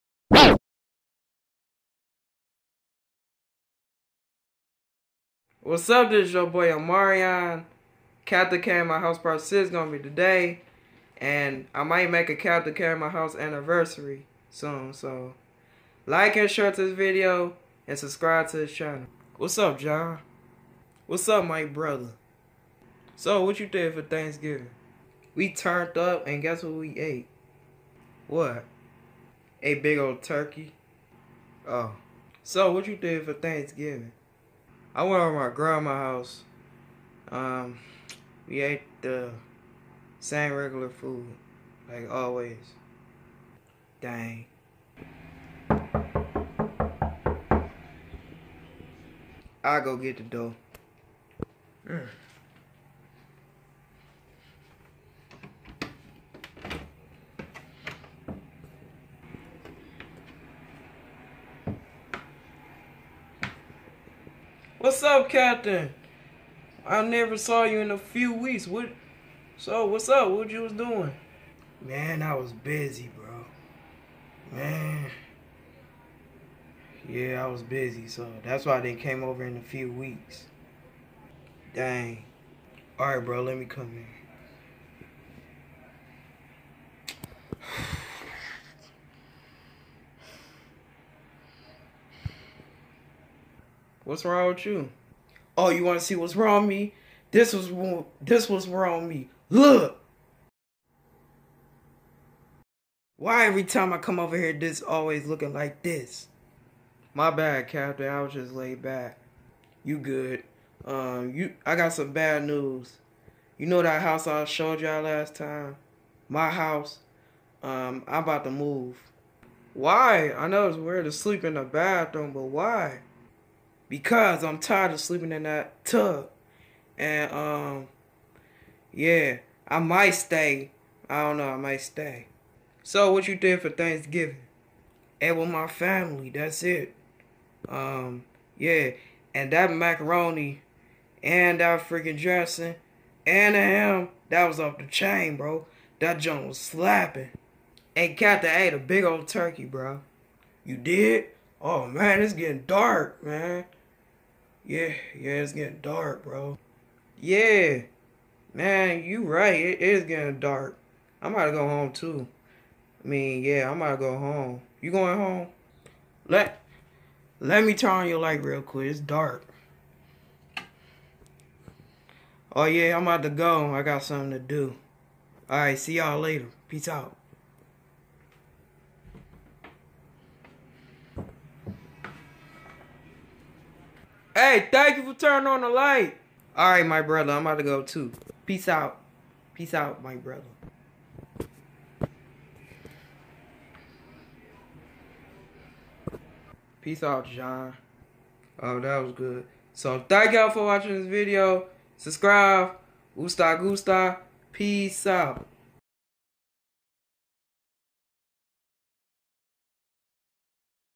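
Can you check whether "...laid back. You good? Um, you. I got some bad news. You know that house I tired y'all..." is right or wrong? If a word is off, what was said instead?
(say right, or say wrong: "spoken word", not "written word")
wrong: "showed", not "tired".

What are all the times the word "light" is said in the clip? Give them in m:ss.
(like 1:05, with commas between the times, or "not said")
2:48, 3:05.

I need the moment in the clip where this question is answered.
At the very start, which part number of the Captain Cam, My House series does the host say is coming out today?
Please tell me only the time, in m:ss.
0:09.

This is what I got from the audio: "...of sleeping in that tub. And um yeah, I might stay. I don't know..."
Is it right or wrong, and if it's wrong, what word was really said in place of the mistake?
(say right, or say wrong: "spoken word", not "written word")
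right.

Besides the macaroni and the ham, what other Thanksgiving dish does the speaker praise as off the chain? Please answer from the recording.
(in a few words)
Dressing.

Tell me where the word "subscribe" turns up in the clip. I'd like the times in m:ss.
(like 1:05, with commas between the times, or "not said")
0:17, 3:21.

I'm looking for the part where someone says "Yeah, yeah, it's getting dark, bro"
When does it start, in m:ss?
2:34.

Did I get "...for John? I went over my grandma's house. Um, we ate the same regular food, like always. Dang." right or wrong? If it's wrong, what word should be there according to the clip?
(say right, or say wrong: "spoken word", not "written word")
wrong: "Thanksgiving", not "John".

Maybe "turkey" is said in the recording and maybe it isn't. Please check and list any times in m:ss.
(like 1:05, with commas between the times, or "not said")
0:30, 2:29.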